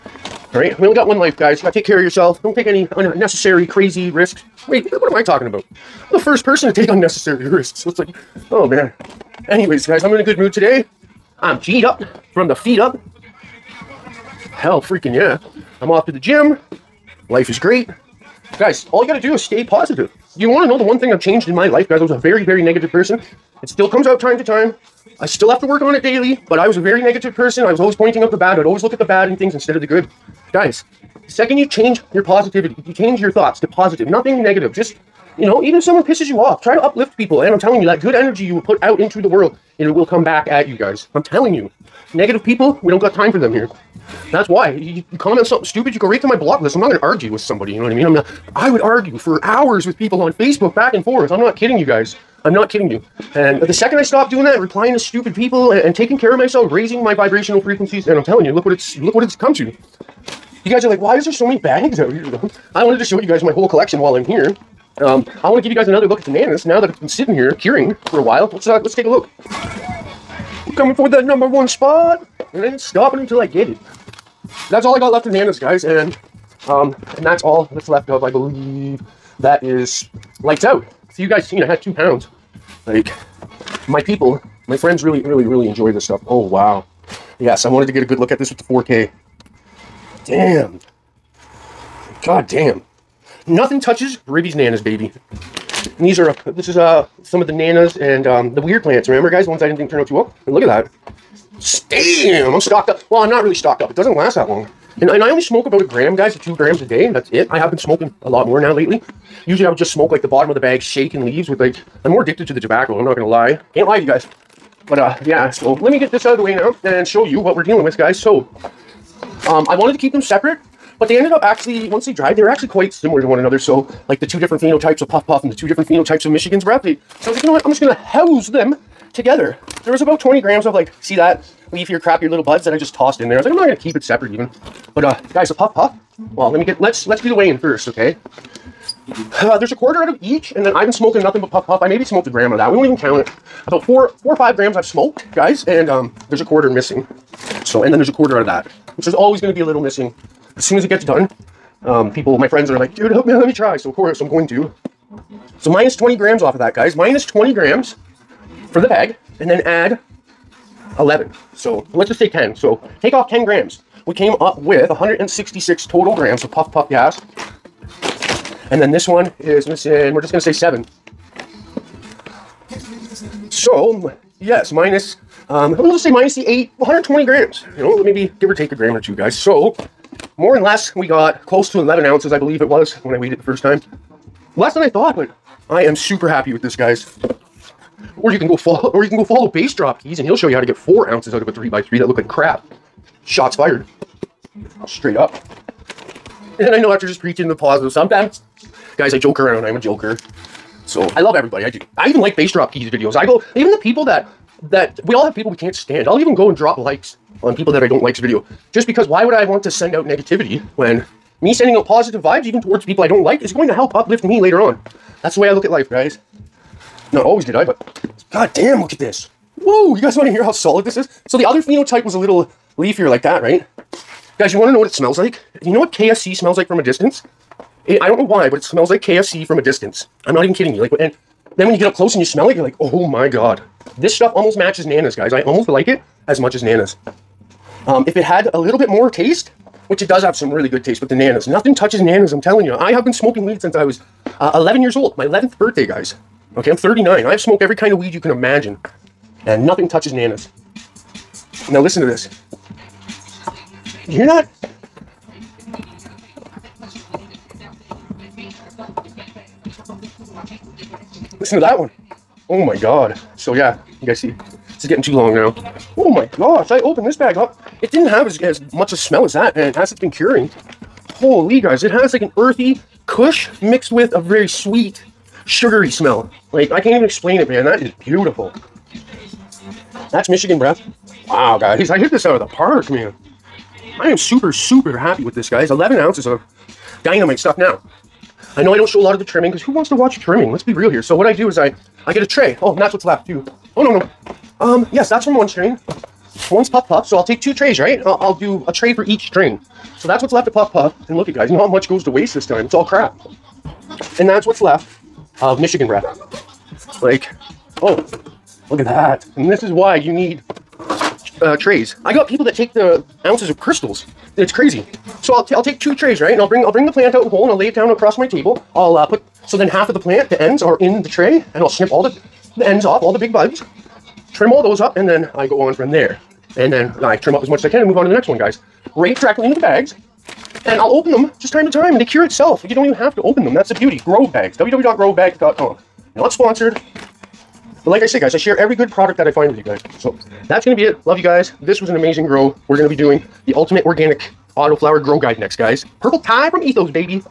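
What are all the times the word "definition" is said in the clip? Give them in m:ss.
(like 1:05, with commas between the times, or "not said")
not said.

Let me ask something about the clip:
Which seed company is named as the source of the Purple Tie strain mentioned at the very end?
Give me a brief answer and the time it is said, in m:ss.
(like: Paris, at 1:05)
Ethos, at 5:46.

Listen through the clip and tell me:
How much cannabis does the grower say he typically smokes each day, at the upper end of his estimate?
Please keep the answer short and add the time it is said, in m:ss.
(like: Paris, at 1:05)
2 grams, at 1:46.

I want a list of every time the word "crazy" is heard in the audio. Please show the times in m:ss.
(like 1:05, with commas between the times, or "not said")
0:03, 5:14.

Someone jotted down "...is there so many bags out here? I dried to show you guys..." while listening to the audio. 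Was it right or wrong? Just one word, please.
wrong.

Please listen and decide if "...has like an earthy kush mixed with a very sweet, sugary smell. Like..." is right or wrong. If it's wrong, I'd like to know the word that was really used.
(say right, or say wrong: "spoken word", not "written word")
right.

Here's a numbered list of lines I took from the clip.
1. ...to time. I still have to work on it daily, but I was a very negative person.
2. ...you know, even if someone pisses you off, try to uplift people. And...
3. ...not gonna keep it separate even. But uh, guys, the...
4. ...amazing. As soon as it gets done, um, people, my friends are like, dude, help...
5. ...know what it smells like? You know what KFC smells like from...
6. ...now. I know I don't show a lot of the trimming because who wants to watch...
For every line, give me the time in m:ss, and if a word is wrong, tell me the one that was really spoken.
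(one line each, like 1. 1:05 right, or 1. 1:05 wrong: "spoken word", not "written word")
1. 0:24 right
2. 0:35 right
3. 2:13 right
4. 2:29 wrong: "missing", not "amazing"
5. 3:44 right
6. 4:47 right.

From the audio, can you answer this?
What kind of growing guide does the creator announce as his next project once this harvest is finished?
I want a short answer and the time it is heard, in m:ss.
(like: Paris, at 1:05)
Ultimate organic autoflower grow guide, at 5:43.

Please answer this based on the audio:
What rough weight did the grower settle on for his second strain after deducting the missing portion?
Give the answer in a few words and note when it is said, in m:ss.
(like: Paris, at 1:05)
120 grams, at 2:56.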